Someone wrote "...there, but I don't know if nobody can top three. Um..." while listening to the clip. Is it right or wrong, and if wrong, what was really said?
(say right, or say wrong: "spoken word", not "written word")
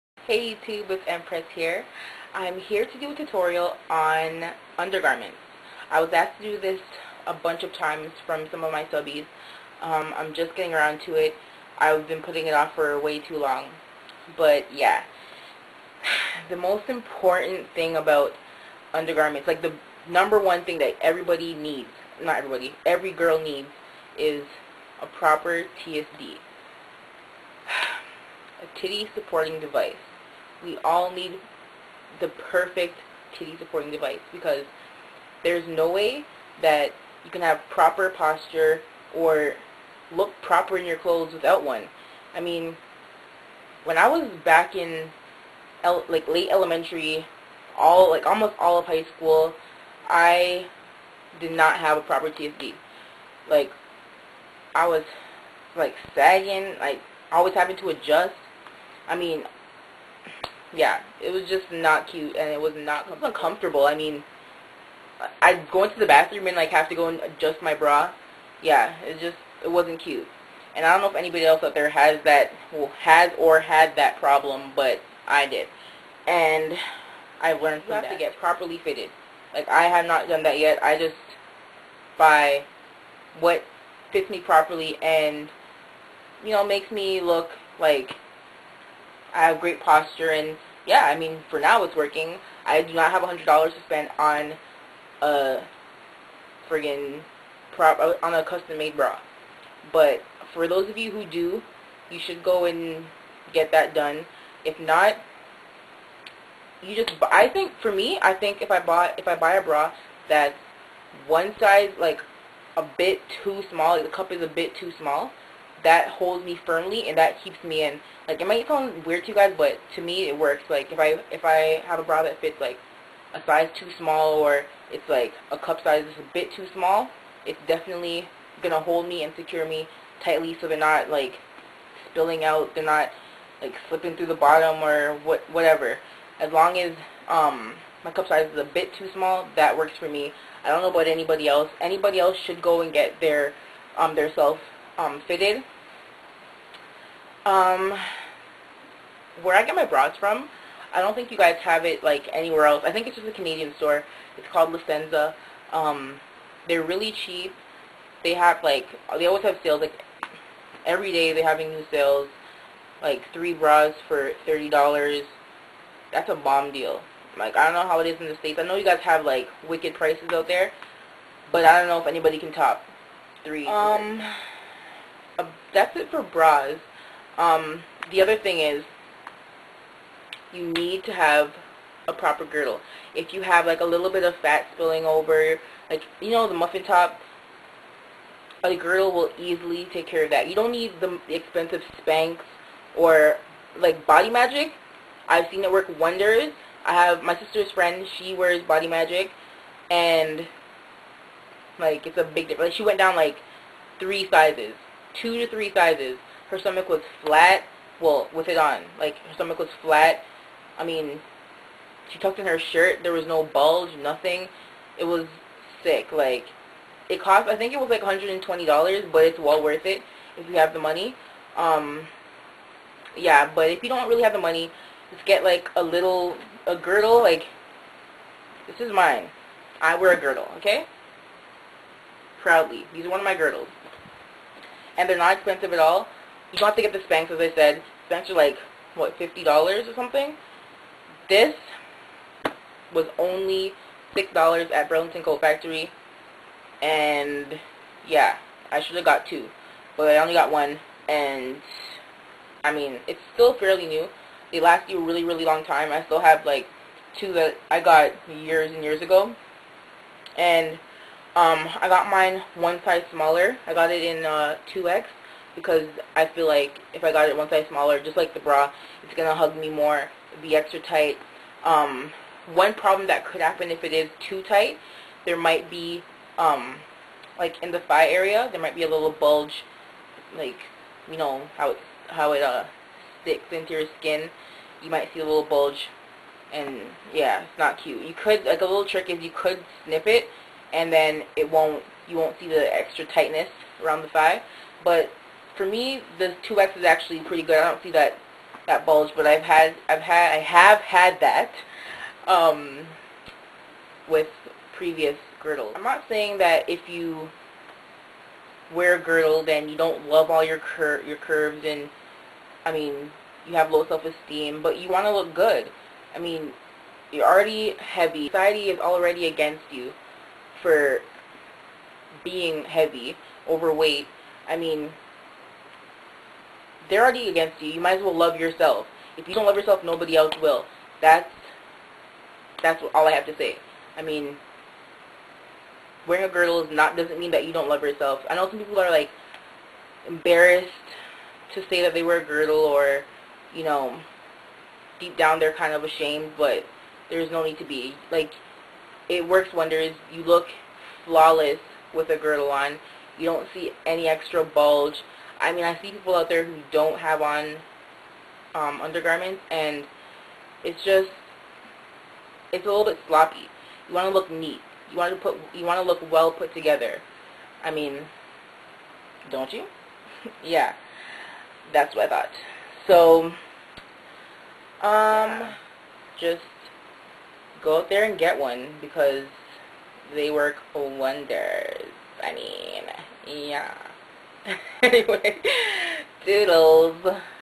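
wrong: "anybody", not "nobody".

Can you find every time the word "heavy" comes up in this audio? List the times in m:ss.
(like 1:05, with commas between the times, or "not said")
5:17, 5:22.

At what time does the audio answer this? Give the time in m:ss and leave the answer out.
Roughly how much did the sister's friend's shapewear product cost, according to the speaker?
3:38.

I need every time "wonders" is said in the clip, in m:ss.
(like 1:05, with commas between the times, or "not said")
3:15, 5:49, 6:20.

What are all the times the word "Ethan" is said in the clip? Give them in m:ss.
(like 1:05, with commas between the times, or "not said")
not said.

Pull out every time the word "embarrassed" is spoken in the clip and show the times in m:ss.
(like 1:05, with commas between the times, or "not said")
5:40.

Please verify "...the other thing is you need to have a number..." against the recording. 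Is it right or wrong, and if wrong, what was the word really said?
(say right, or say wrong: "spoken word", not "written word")
wrong: "proper", not "number".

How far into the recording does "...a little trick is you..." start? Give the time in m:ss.
4:48.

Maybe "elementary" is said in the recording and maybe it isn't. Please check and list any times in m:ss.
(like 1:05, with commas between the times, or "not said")
0:46.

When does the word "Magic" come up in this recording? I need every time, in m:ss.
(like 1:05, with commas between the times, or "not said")
3:14, 3:18.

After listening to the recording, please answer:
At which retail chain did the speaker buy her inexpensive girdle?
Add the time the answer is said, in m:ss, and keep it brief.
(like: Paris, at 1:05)
Burlington Coat Factory, at 4:04.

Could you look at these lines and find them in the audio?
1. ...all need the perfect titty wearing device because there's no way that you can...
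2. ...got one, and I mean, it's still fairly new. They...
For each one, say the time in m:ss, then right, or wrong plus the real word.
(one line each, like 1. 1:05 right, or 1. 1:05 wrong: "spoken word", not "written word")
1. 0:30 wrong: "supporting", not "wearing"
2. 4:10 right.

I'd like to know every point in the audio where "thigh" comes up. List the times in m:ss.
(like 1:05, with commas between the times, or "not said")
4:37, 4:54.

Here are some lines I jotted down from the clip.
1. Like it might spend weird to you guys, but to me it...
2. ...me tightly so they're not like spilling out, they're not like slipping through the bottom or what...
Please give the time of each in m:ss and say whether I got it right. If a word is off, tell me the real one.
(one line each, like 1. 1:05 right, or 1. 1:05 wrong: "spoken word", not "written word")
1. 1:58 wrong: "sound", not "spend"
2. 2:09 right.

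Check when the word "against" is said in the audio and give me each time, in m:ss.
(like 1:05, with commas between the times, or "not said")
5:19, 5:27.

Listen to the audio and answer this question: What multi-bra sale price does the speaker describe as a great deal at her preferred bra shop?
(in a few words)
3 bras for $30.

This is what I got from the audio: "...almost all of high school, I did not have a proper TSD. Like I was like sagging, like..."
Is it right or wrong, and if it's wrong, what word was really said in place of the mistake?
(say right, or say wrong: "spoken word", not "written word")
right.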